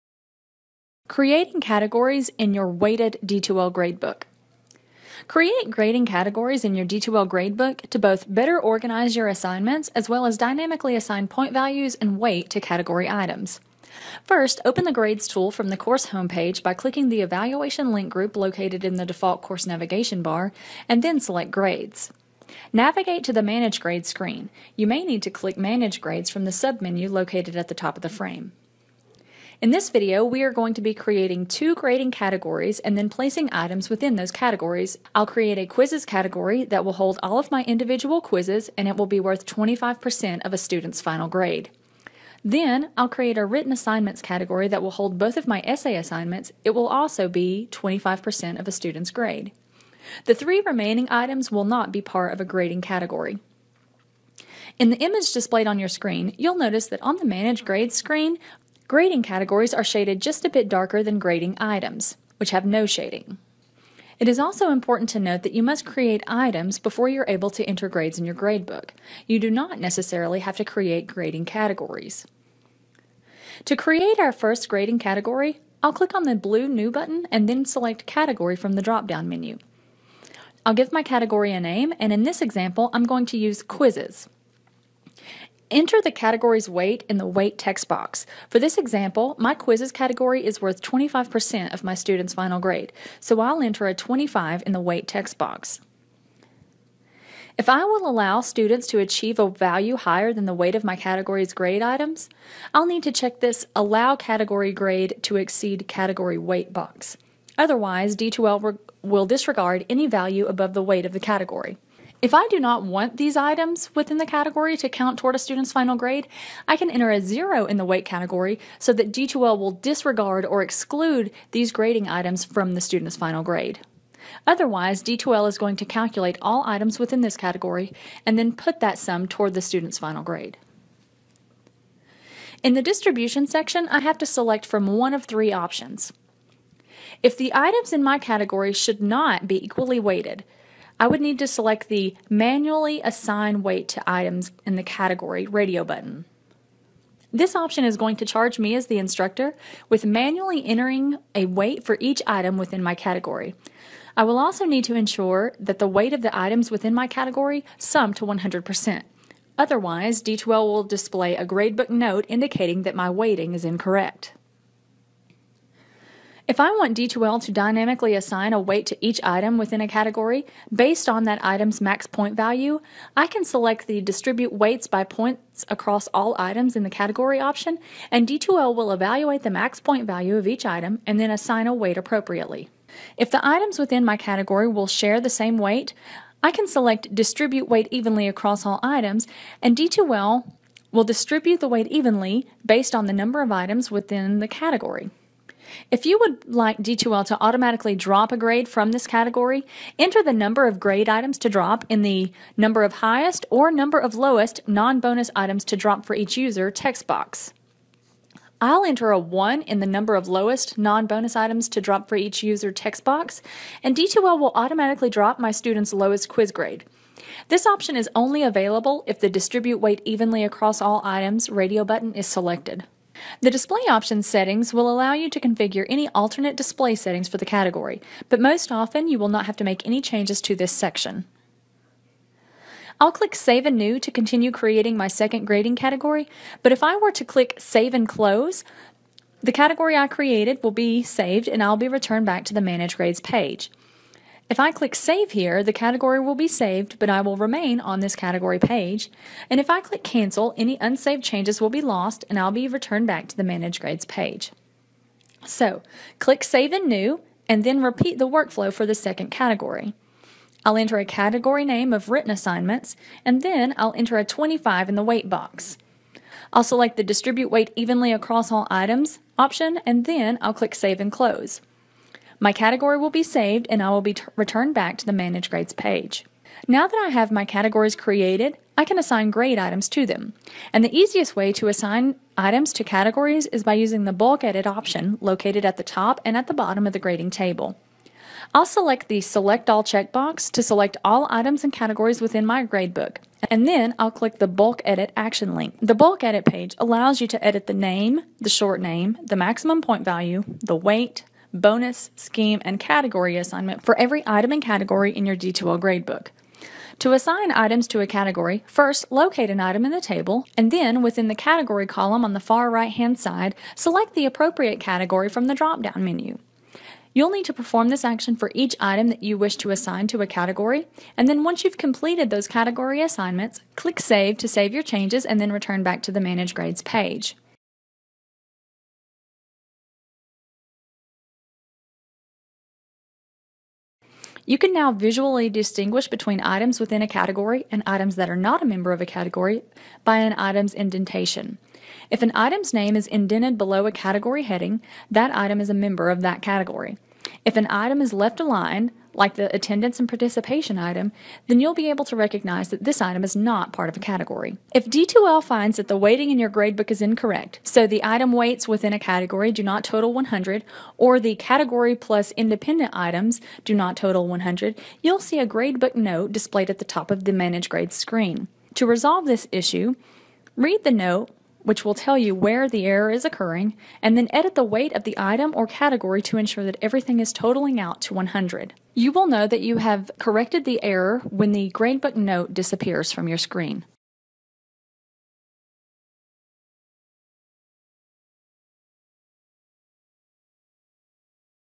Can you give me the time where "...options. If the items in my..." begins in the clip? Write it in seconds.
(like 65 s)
135 s.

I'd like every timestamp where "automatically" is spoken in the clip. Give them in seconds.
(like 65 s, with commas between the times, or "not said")
197 s, 214 s.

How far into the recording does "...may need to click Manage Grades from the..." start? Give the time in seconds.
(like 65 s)
24 s.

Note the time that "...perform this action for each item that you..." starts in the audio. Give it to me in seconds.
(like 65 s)
317 s.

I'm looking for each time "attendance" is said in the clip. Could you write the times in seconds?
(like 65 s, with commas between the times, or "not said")
349 s.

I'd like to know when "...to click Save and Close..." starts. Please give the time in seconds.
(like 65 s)
237 s.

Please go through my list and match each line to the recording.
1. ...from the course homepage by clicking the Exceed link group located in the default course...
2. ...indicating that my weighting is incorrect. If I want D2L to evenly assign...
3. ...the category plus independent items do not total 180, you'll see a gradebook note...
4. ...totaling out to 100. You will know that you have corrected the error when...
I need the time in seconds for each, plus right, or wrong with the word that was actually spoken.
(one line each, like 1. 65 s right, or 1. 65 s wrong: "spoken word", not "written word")
1. 15 s wrong: "Evaluation", not "Exceed"
2. 162 s wrong: "dynamically", not "evenly"
3. 361 s wrong: "100", not "180"
4. 377 s right.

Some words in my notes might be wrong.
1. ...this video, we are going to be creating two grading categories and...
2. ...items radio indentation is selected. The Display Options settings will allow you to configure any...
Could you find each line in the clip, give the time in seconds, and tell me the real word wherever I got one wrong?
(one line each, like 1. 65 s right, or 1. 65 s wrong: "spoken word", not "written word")
1. 29 s right
2. 221 s wrong: "button", not "indentation".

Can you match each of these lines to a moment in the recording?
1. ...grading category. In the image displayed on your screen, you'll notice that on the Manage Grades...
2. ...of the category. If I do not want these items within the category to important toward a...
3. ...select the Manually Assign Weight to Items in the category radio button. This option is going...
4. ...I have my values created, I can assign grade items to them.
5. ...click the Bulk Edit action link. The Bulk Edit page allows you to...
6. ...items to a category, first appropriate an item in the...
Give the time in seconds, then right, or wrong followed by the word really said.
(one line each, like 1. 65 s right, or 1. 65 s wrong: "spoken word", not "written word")
1. 52 s right
2. 111 s wrong: "count", not "important"
3. 141 s right
4. 277 s wrong: "categories", not "values"
5. 294 s right
6. 307 s wrong: "locate", not "appropriate".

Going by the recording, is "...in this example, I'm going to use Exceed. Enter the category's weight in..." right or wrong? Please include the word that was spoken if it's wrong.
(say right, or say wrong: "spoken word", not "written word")
wrong: "Quizzes", not "Exceed".